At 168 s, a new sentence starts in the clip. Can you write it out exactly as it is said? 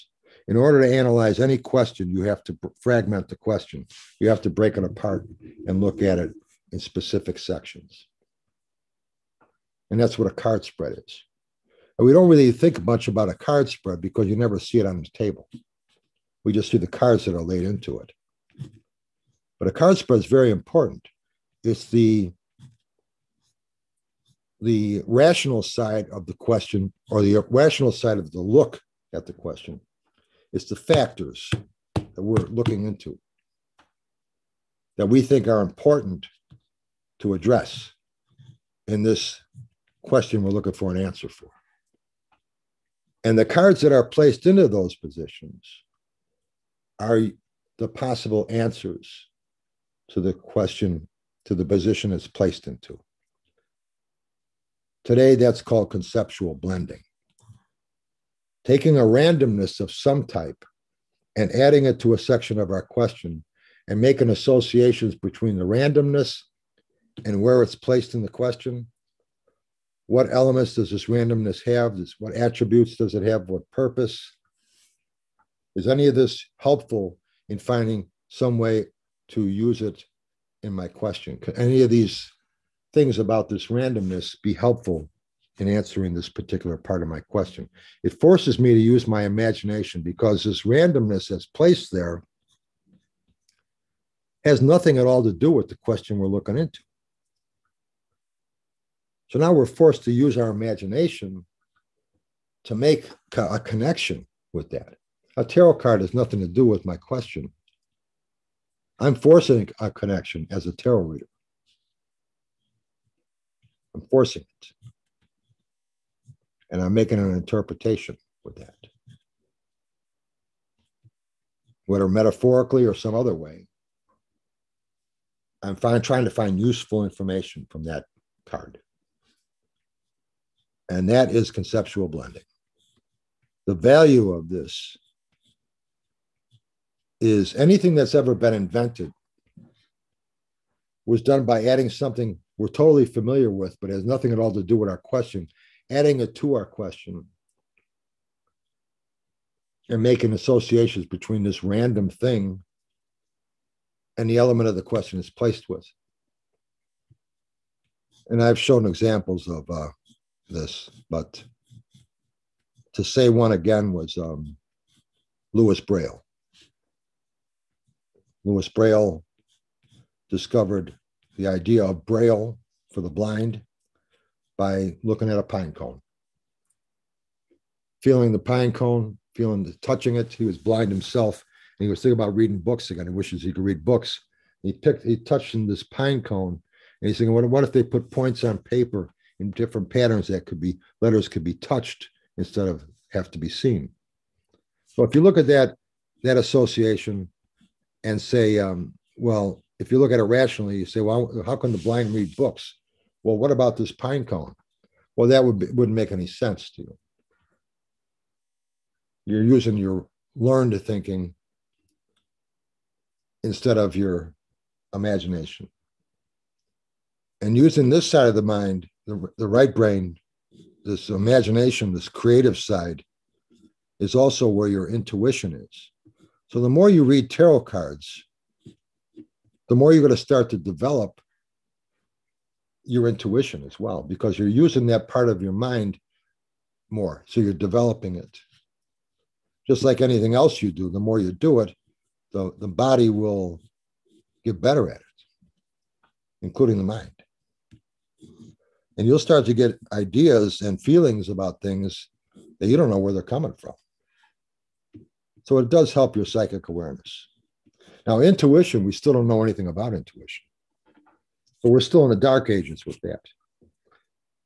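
Louis Braille discovered the idea of Braille for the blind by looking at a pine cone.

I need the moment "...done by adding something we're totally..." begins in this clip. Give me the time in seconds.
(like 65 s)
141 s.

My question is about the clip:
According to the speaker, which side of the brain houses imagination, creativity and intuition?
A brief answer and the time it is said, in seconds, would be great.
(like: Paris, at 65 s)
Right brain, at 219 s.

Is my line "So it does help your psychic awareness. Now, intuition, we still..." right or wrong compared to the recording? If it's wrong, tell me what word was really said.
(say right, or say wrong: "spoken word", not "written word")
right.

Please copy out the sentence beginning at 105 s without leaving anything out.
A tarot card has nothing to do with my question.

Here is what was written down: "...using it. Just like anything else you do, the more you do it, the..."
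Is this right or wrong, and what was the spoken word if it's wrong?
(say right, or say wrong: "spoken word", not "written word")
wrong: "developing", not "using".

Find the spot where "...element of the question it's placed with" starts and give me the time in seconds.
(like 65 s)
154 s.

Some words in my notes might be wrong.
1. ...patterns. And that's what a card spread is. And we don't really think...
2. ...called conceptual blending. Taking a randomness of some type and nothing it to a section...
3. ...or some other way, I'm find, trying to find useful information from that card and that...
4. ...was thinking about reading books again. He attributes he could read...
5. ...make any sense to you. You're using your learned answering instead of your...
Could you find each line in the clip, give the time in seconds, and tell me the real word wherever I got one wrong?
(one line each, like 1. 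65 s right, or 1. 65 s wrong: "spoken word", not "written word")
1. 7 s wrong: "sections", not "patterns"
2. 55 s wrong: "adding", not "nothing"
3. 122 s right
4. 181 s wrong: "wishes", not "attributes"
5. 205 s wrong: "thinking", not "answering".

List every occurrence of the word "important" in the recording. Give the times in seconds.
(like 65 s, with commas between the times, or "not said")
20 s, 35 s.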